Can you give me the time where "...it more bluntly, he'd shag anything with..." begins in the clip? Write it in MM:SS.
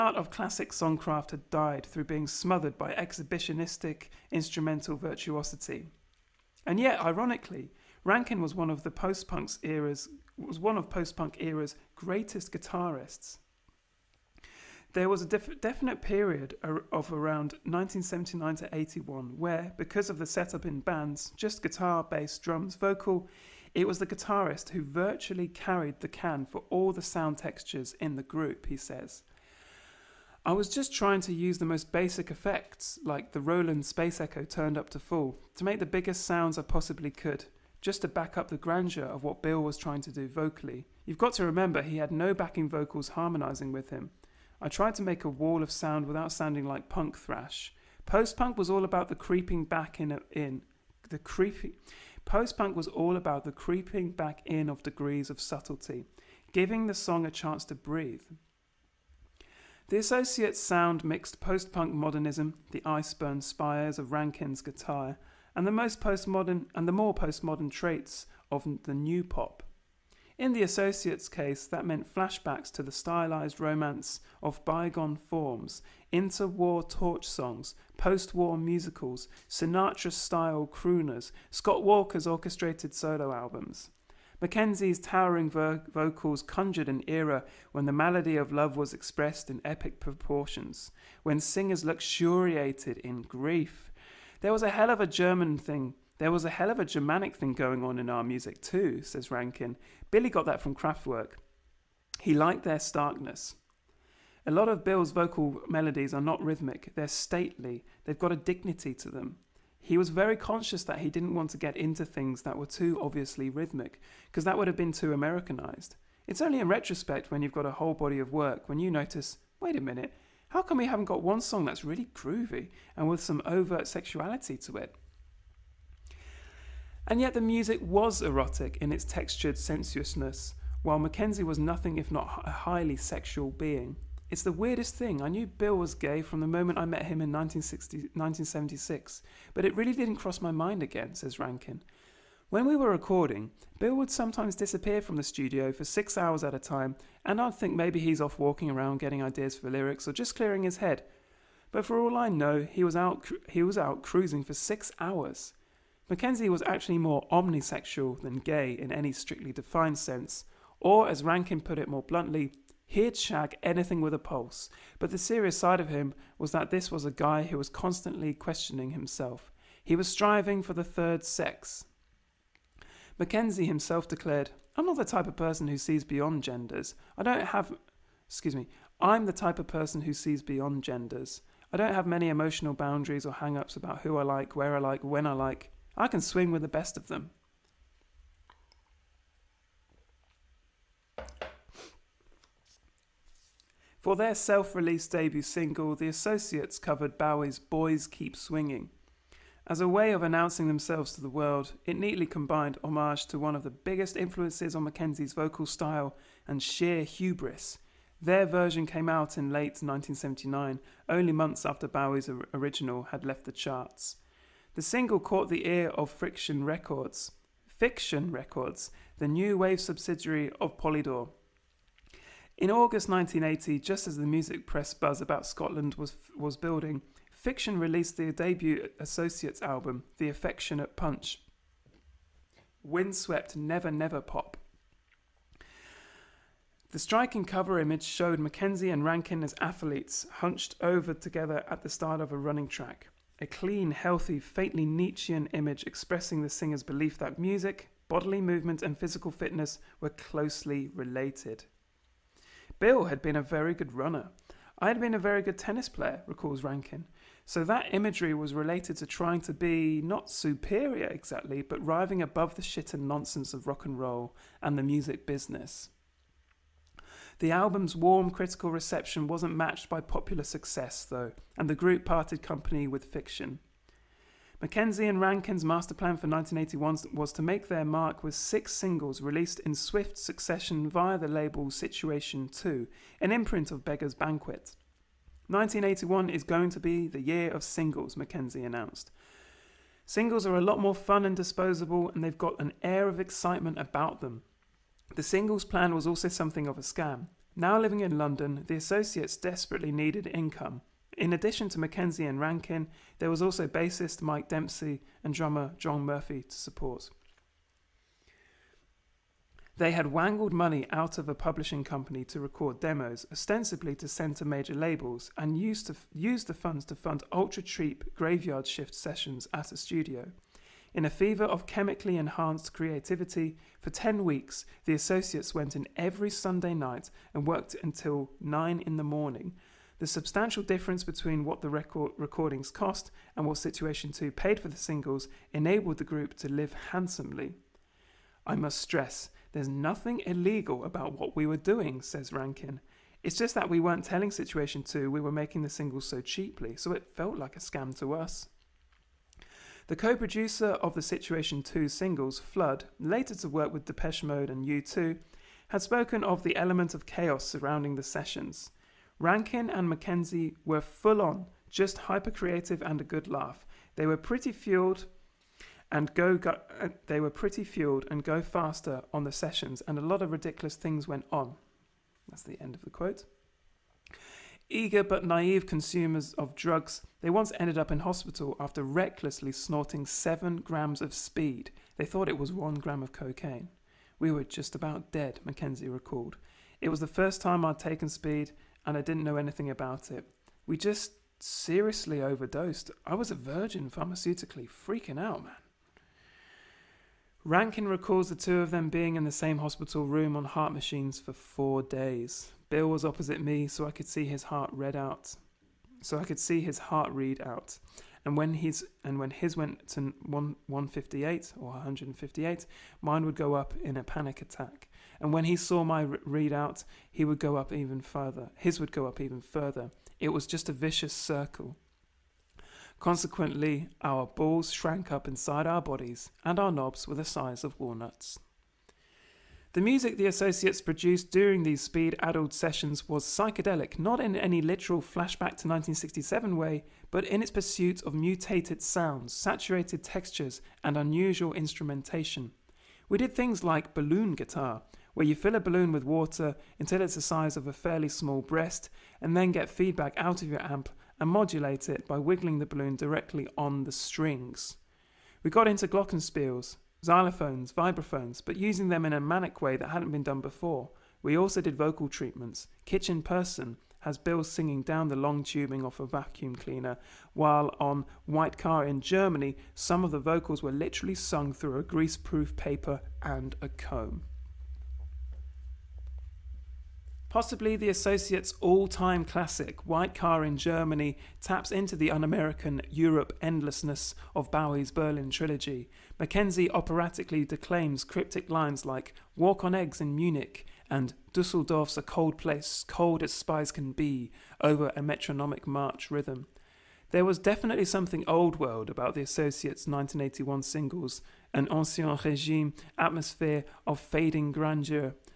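02:41.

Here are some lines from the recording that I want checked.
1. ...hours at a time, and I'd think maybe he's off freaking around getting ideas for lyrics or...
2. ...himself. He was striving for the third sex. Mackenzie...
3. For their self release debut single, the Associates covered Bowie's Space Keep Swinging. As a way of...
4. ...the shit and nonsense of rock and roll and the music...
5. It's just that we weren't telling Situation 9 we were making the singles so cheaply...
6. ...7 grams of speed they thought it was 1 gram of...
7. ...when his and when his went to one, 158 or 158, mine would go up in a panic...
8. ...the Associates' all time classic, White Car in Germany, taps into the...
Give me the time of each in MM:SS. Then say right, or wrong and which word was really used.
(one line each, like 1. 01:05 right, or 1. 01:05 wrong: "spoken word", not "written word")
1. 02:26 wrong: "walking", not "freaking"
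2. 02:48 right
3. 03:13 wrong: "Boys", not "Space"
4. 04:22 right
5. 05:43 wrong: "2", not "9"
6. 06:20 right
7. 06:48 right
8. 07:57 right.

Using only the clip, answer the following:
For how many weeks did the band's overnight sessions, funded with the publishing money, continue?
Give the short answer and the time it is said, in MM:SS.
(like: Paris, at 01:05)
10, at 05:23.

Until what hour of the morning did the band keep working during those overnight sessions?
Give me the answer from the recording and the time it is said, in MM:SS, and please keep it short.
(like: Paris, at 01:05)
9, at 05:28.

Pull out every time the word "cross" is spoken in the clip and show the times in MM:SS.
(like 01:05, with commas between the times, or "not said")
02:20.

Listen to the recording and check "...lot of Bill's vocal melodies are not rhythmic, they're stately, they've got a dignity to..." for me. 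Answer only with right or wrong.
right.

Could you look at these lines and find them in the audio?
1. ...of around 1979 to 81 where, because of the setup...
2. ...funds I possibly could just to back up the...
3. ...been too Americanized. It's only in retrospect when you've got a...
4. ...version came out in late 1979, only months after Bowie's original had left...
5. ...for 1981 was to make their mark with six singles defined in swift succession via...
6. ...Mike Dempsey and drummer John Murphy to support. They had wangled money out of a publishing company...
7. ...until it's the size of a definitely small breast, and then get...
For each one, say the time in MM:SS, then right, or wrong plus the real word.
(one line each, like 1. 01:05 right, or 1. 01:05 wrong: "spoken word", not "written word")
1. 00:16 right
2. 00:36 wrong: "sounds", not "funds"
3. 01:54 right
4. 03:28 right
5. 04:36 wrong: "released", not "defined"
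6. 05:04 right
7. 07:26 wrong: "fairly", not "definitely".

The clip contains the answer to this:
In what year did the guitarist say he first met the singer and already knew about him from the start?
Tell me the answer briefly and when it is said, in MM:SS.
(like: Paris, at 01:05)
1976, at 02:17.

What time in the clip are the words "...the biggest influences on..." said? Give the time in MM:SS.
03:23.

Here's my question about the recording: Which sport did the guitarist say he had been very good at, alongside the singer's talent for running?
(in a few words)
Tennis.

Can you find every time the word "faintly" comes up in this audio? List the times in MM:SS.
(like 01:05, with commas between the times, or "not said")
04:04.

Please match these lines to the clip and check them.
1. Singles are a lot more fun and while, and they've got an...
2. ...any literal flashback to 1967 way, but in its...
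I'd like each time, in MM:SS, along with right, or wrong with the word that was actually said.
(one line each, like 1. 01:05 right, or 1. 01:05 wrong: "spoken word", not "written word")
1. 04:50 wrong: "disposable", not "while"
2. 07:14 right.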